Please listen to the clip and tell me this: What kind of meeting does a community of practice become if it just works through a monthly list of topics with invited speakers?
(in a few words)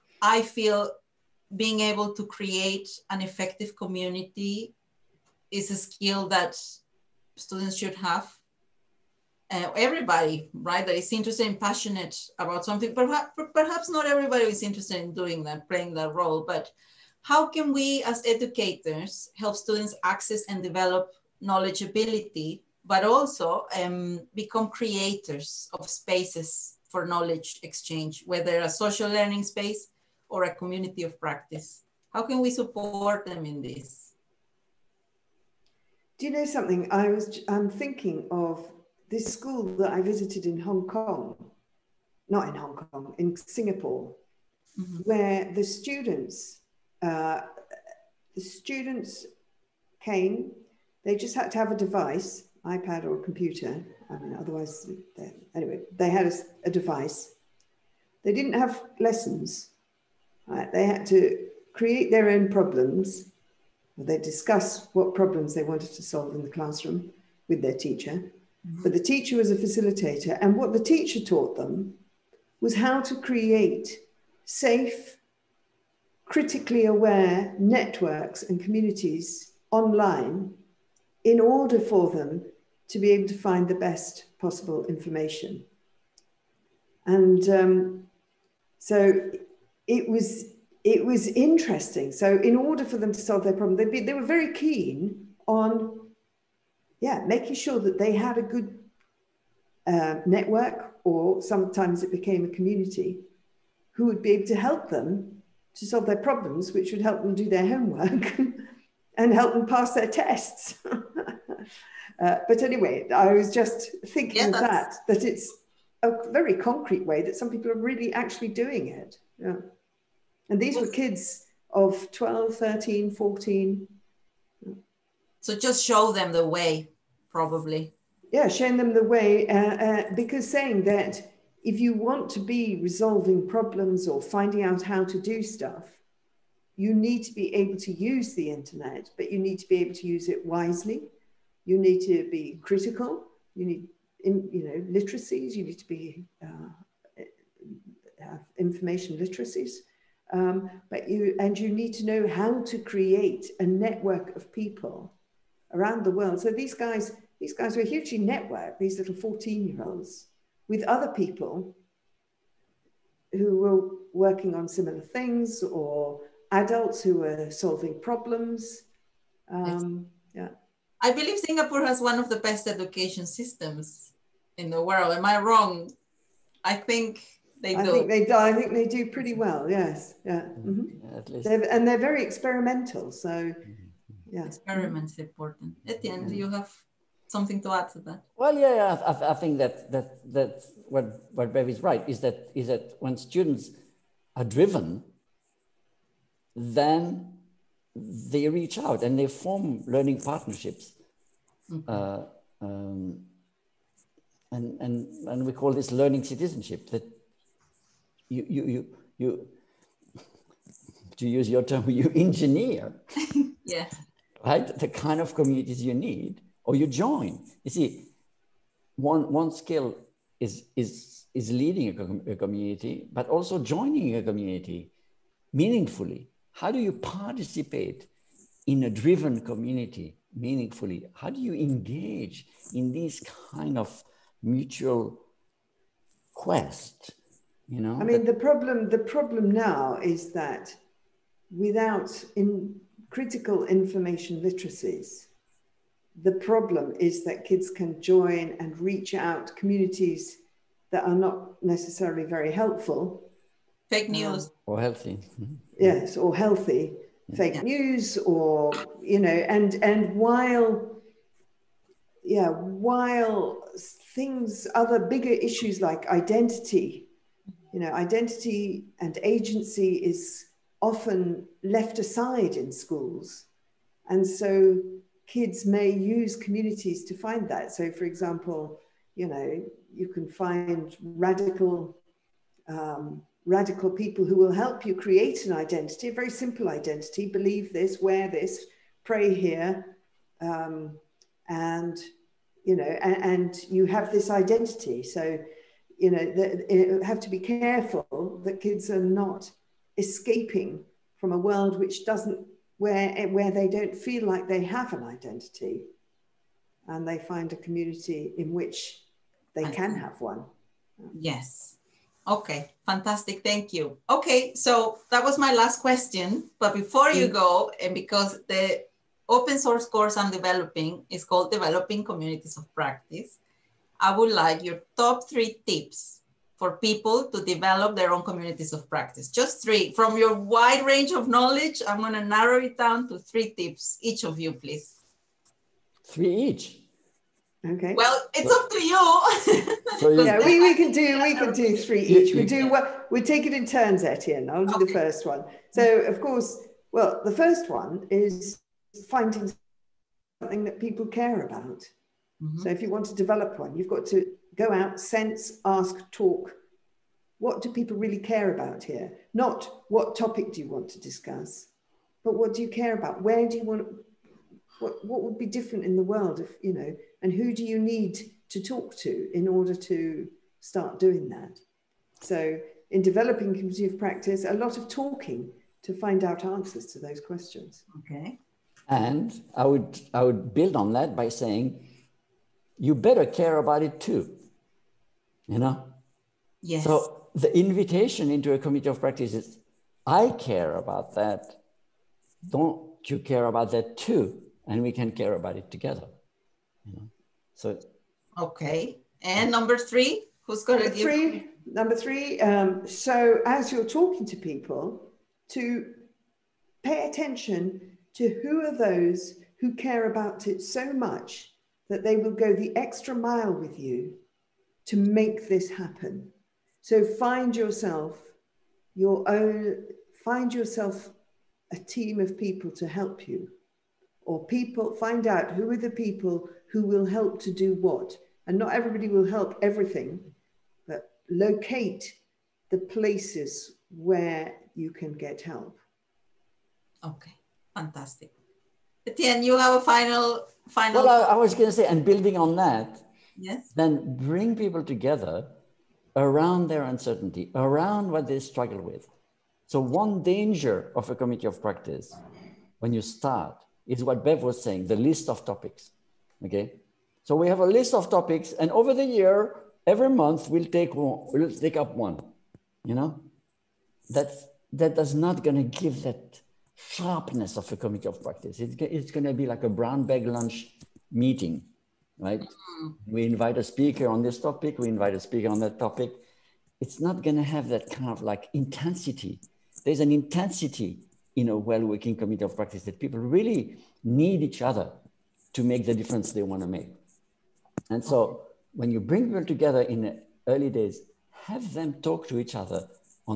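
brown bag lunch meeting.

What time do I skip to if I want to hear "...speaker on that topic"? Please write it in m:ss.
7:55.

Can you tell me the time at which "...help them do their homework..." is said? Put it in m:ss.
1:47.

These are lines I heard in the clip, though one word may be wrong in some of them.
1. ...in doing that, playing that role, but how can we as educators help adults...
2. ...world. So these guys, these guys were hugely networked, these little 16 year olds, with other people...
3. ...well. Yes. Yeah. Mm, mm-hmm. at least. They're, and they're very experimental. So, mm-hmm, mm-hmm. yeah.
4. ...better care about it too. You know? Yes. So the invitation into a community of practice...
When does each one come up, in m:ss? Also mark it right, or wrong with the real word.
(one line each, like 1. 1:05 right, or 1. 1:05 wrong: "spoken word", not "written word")
1. 0:15 wrong: "students", not "adults"
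2. 2:36 wrong: "14", not "16"
3. 2:59 right
4. 6:22 right.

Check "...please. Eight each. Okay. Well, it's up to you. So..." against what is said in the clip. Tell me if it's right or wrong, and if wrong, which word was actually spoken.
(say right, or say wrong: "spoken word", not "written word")
wrong: "Three", not "Eight".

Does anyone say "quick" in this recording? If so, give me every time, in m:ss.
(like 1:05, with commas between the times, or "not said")
not said.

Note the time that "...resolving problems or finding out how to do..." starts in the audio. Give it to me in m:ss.
2:12.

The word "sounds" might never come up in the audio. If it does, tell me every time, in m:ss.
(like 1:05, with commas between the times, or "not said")
not said.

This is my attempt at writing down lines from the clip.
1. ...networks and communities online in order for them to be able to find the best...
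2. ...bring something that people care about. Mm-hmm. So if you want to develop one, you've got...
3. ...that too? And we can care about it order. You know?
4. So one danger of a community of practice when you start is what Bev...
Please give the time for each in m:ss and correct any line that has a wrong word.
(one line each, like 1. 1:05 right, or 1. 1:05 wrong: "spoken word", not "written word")
1. 1:17 right
2. 5:49 wrong: "finding", not "bring"
3. 6:33 wrong: "together", not "order"
4. 7:29 right.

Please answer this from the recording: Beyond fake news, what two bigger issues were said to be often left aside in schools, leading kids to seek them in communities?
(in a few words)
identity and agency.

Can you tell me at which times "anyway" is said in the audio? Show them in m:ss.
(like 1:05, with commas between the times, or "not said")
0:55, 1:52.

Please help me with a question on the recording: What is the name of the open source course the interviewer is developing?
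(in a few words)
Developing Communities of Practice.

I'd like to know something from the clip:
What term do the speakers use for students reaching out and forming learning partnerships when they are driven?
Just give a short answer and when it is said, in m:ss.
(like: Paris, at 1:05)
learning citizenship, at 3:25.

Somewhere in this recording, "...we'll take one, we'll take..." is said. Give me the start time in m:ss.
7:40.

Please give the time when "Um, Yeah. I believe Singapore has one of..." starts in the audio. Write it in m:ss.
2:49.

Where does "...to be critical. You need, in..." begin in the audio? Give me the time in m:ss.
2:22.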